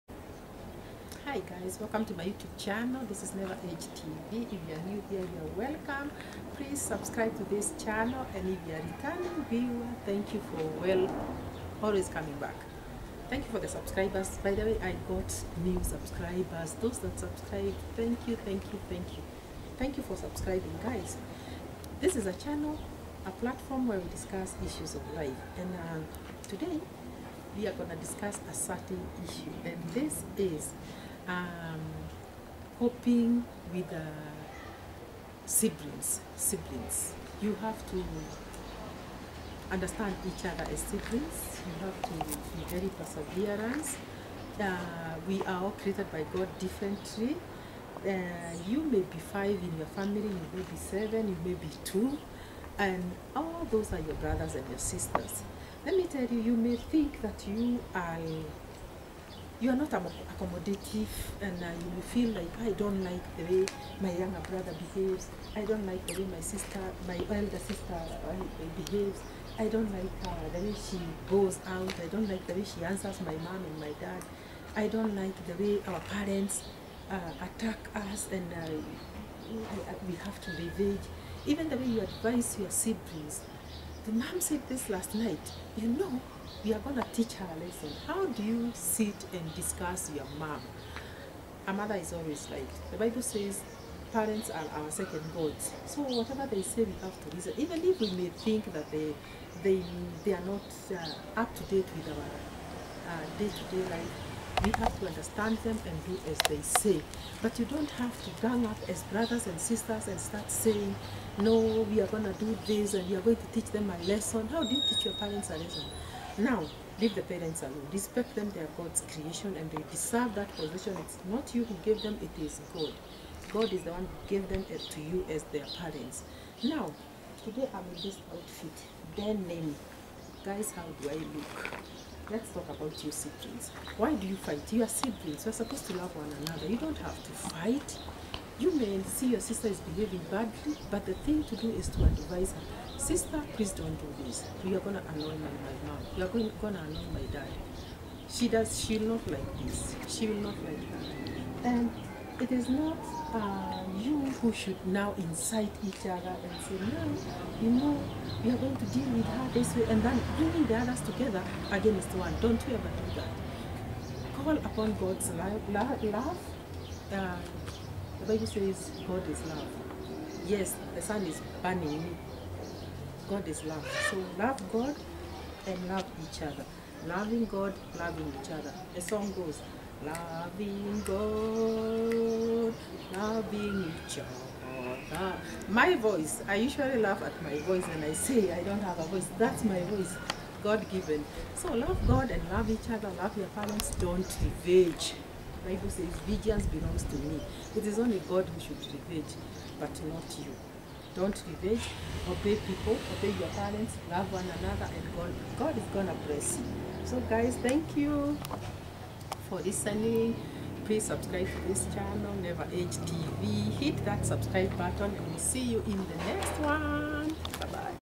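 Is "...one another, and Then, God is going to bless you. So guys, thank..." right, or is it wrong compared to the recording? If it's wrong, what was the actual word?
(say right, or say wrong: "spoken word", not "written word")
wrong: "God", not "Then".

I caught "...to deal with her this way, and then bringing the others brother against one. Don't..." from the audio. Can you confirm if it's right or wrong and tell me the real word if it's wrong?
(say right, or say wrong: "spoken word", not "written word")
wrong: "together", not "brother".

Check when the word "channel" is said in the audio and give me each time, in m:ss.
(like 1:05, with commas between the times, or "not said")
0:02, 0:07, 0:22, 3:31.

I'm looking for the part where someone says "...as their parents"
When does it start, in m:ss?
2:05.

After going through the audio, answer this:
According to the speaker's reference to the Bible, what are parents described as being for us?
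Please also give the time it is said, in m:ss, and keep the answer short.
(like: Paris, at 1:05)
second gods, at 1:34.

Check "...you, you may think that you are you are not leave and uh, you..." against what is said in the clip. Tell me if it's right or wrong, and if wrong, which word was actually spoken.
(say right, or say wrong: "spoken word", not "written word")
wrong: "accommodative", not "leave".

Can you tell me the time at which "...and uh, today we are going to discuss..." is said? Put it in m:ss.
0:25.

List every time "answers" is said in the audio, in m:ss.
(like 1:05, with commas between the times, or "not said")
1:12.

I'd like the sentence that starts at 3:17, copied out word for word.
It is only God who should revenge, but not you.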